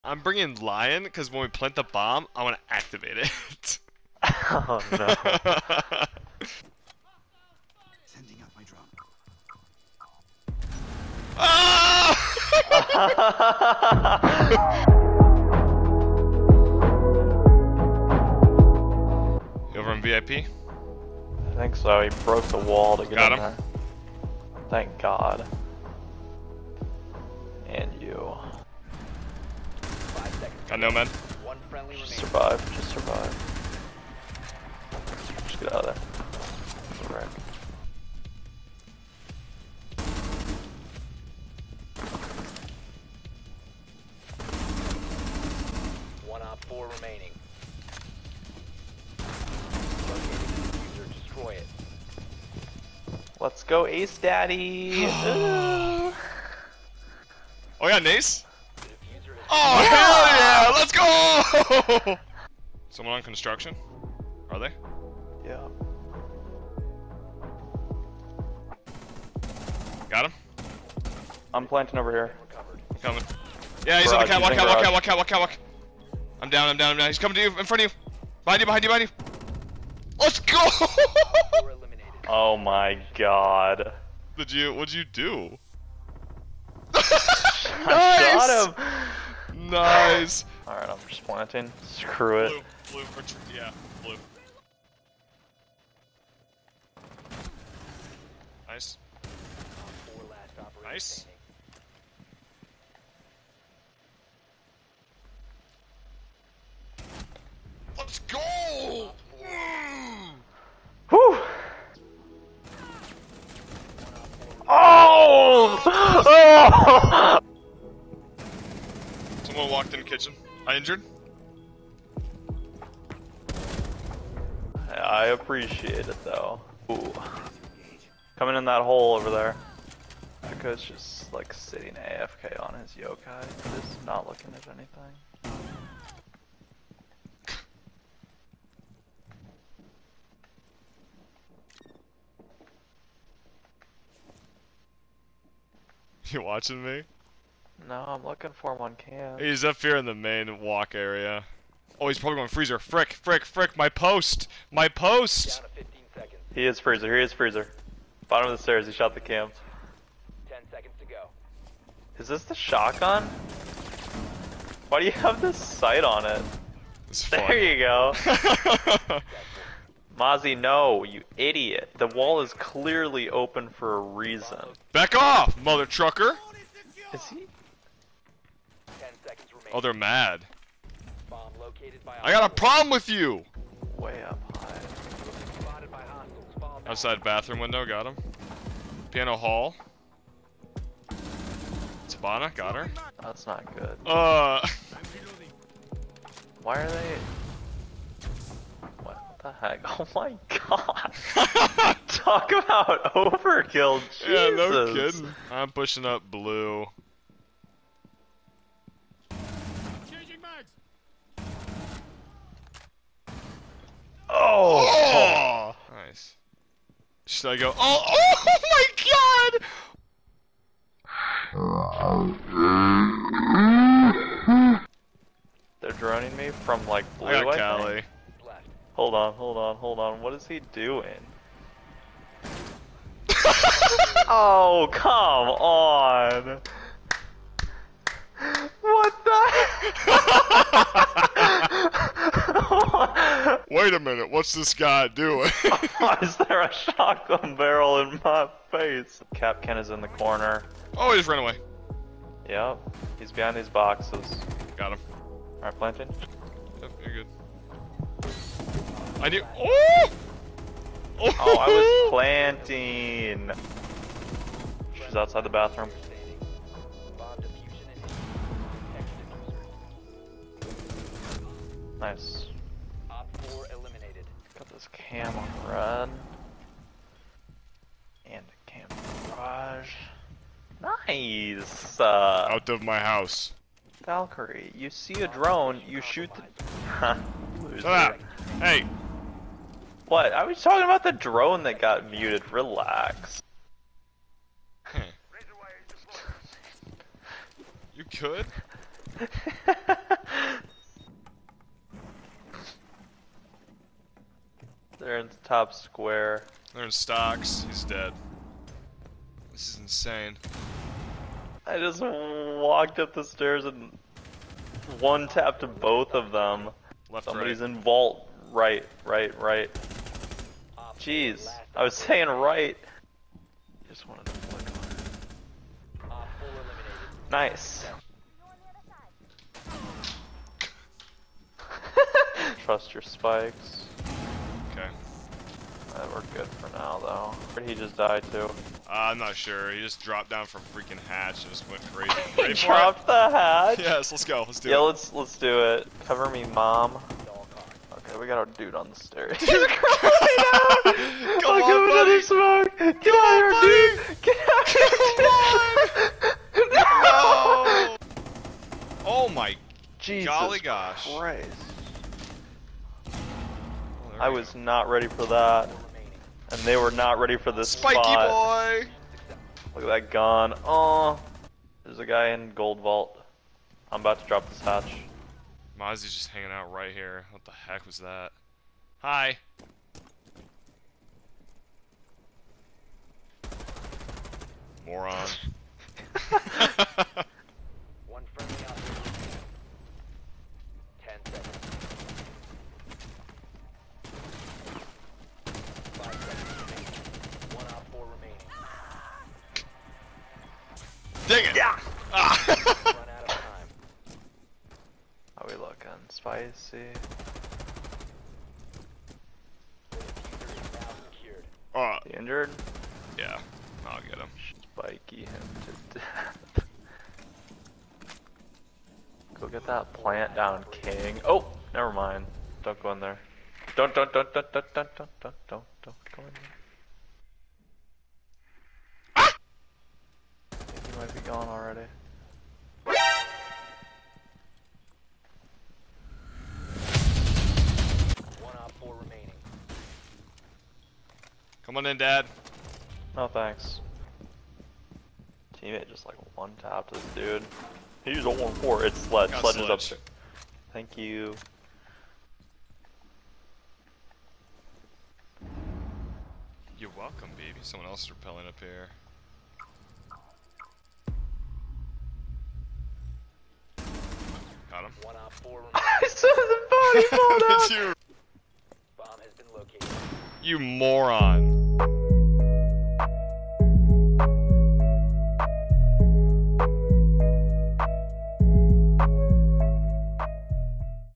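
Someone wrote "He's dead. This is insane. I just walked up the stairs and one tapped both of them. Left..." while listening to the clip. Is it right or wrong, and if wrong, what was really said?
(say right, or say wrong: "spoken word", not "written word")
right.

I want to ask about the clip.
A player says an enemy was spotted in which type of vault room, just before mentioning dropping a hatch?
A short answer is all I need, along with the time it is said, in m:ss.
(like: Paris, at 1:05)
Gold vault, at 6:12.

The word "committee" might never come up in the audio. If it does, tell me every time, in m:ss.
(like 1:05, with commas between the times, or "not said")
not said.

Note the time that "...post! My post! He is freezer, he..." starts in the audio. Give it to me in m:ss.
2:33.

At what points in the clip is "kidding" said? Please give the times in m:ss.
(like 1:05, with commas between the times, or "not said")
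3:24.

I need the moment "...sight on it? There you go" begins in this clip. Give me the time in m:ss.
2:45.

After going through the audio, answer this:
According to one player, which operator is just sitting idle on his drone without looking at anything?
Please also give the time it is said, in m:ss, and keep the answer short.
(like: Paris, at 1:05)
Echo, at 2:10.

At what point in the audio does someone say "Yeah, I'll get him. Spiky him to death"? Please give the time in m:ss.
6:53.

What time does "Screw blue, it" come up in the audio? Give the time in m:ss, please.
1:31.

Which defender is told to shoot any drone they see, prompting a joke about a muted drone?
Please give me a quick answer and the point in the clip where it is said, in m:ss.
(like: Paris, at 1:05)
Valkyrie, at 4:44.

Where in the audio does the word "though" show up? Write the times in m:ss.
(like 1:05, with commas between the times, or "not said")
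2:06, 5:36.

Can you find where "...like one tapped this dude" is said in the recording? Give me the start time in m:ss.
7:26.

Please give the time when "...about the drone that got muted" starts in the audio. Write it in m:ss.
4:50.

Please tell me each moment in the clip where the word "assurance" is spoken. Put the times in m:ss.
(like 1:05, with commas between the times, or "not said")
not said.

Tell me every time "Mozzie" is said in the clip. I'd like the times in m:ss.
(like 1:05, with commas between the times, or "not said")
2:50, 6:15.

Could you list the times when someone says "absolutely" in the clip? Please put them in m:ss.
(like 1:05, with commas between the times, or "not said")
not said.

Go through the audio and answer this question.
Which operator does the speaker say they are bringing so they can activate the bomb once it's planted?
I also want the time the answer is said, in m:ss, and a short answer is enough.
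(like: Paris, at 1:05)
Lion, at 0:00.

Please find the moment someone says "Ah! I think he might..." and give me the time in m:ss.
7:09.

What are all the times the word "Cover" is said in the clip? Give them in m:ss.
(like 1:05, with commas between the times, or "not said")
5:46.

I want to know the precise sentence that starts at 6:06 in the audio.
And they were not ready for this Spiky spot.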